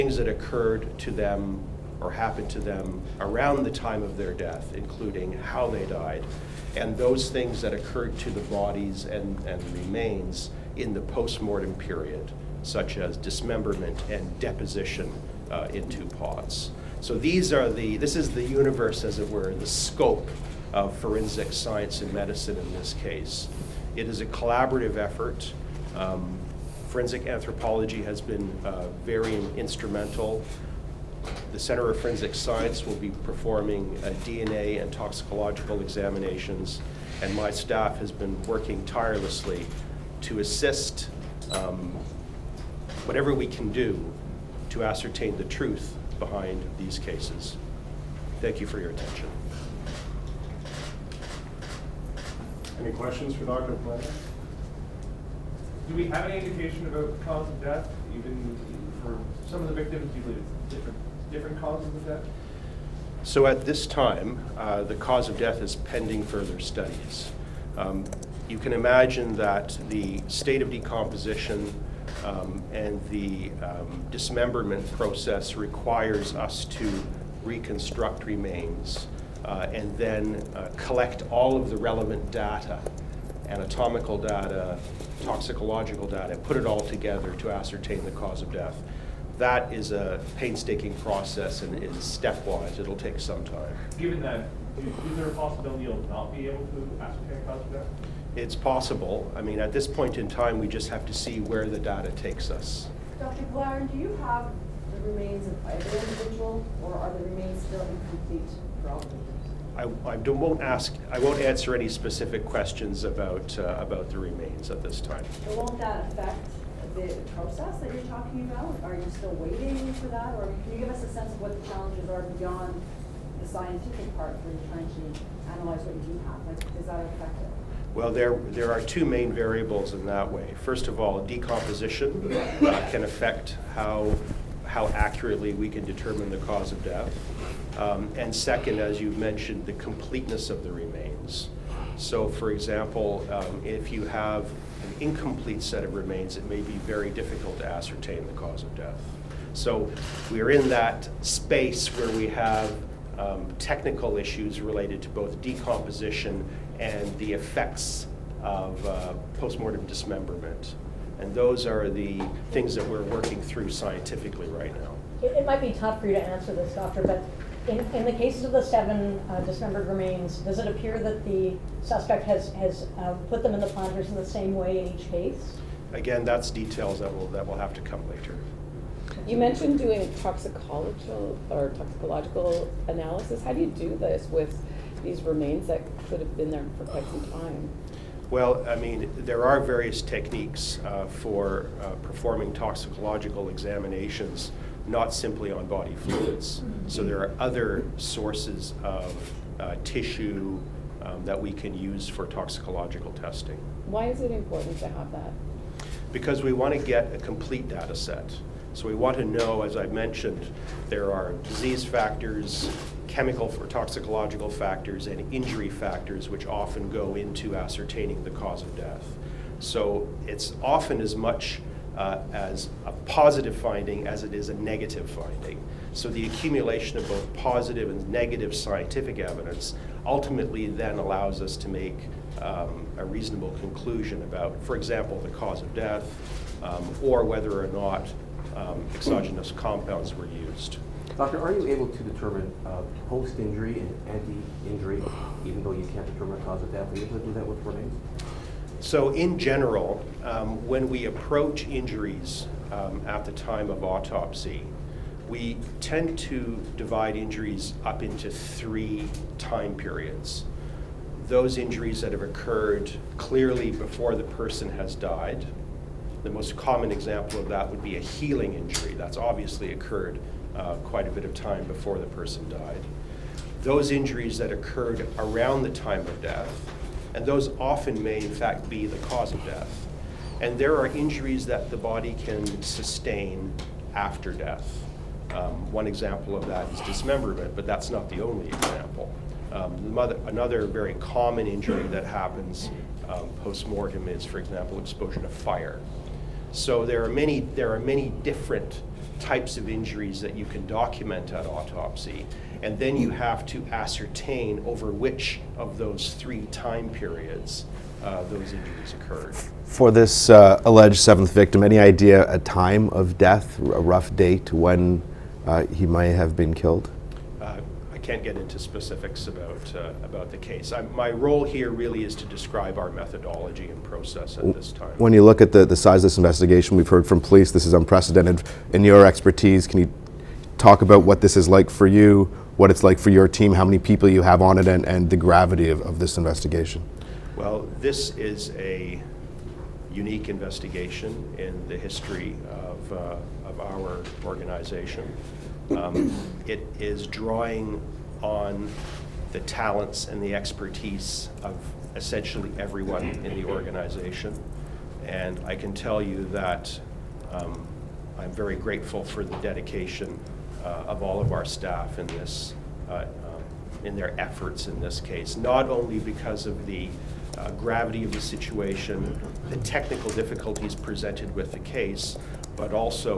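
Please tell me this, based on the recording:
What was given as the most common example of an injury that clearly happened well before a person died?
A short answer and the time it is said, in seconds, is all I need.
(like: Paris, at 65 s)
A healing injury, at 268 s.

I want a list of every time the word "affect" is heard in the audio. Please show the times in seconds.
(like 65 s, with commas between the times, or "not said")
116 s, 133 s.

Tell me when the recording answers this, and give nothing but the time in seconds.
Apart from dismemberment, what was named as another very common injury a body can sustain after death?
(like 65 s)
294 s.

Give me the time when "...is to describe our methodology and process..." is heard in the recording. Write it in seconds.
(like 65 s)
322 s.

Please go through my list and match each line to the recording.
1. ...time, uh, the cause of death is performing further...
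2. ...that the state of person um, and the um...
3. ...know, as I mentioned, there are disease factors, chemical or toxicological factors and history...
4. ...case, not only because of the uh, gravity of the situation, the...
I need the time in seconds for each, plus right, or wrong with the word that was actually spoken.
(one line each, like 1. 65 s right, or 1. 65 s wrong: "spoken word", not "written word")
1. 63 s wrong: "pending", not "performing"
2. 69 s wrong: "decomposition", not "person"
3. 209 s wrong: "injury", not "history"
4. 364 s right.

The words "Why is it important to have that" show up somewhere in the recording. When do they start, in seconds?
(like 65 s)
203 s.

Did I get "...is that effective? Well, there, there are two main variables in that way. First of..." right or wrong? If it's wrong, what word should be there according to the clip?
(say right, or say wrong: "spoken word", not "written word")
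right.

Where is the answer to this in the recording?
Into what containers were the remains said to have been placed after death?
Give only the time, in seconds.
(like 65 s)
16 s.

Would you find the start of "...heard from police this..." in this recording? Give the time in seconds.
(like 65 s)
326 s.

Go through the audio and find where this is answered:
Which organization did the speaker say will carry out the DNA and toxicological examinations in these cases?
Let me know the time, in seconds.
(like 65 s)
31 s.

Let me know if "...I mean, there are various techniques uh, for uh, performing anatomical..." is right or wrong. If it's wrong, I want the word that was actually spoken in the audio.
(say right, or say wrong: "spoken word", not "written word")
wrong: "toxicological", not "anatomical".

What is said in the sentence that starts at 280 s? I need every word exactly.
And there are injuries that the body can sustain after death.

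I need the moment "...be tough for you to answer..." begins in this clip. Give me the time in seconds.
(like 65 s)
165 s.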